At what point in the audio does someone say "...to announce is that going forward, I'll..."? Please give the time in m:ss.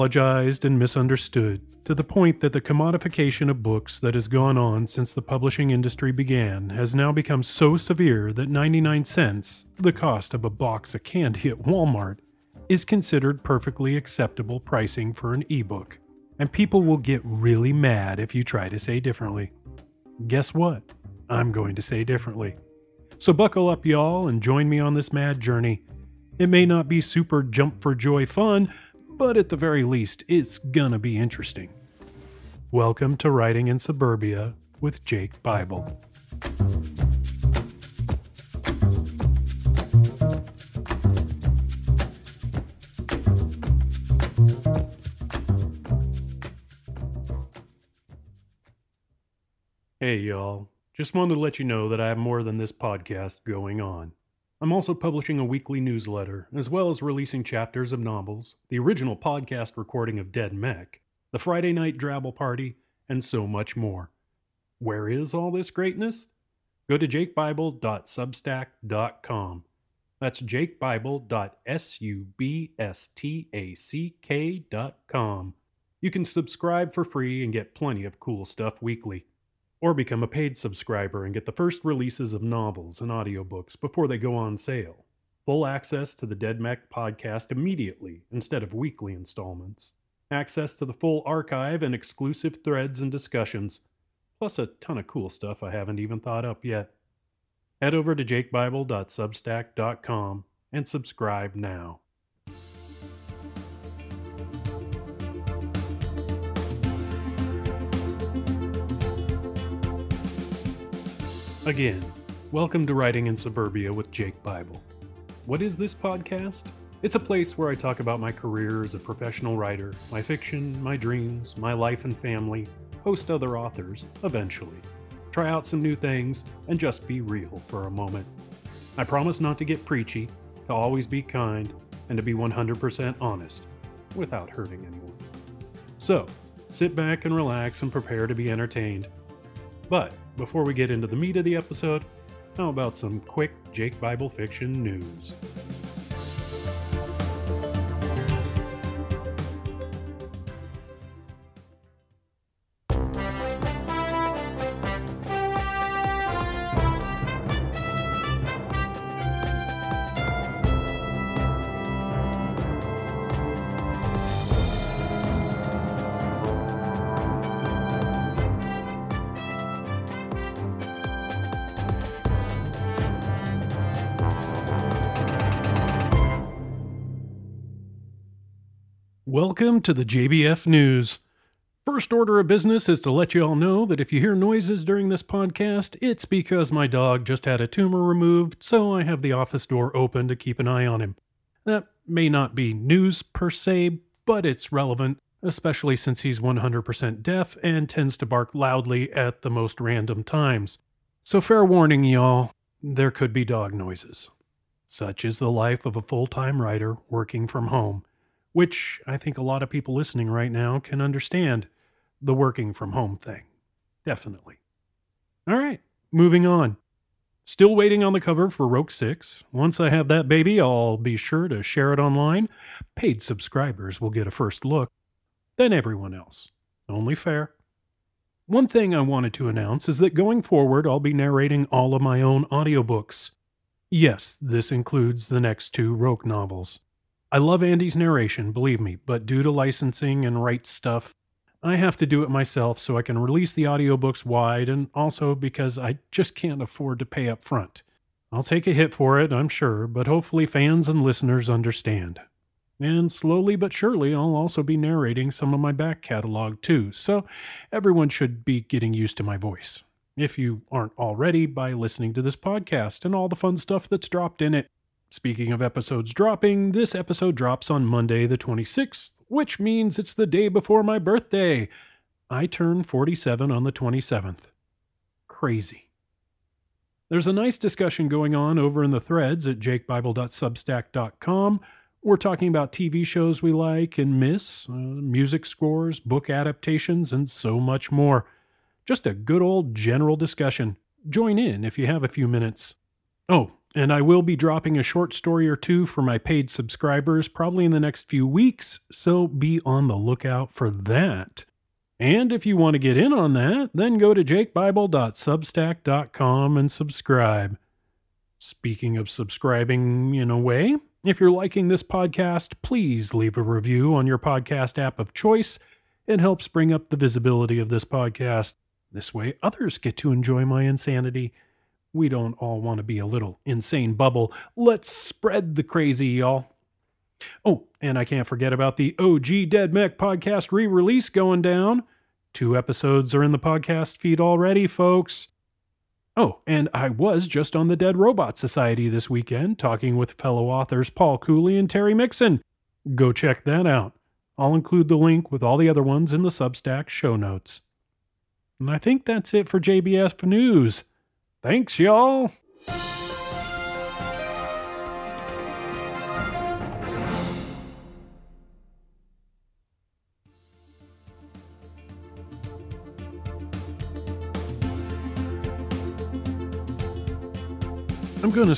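3:49.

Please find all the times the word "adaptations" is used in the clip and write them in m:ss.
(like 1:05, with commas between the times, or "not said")
4:46.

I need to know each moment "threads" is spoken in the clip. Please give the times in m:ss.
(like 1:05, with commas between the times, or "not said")
1:32, 4:39.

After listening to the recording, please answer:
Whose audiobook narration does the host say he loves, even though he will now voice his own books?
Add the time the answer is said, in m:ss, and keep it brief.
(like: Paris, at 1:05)
Andy, at 3:57.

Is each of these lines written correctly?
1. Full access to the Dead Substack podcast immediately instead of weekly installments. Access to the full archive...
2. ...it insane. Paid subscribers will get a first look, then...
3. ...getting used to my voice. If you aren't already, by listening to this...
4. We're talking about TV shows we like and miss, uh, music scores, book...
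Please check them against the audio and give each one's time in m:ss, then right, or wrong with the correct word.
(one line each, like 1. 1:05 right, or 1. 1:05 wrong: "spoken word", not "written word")
1. 1:25 wrong: "Mech", not "Substack"
2. 3:41 wrong: "online", not "insane"
3. 4:18 right
4. 4:42 right.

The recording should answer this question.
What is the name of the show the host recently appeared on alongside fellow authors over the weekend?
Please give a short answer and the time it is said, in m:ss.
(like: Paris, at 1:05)
Dead Robots Society, at 5:37.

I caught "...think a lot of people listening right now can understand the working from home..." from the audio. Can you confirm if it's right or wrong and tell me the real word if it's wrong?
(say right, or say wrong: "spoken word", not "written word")
right.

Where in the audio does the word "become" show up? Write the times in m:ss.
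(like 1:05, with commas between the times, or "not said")
0:07, 1:19.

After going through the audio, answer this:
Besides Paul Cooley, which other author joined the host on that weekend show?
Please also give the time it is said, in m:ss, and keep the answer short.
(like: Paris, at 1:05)
Terry Mixon, at 5:41.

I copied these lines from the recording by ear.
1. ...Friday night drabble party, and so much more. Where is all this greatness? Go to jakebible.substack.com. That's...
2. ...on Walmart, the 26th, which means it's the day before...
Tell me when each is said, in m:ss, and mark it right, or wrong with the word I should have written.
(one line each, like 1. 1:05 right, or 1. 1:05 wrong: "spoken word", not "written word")
1. 1:01 right
2. 4:27 wrong: "Monday", not "Walmart".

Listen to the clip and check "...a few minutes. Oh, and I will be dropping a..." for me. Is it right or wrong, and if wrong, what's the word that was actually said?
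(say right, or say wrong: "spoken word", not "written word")
right.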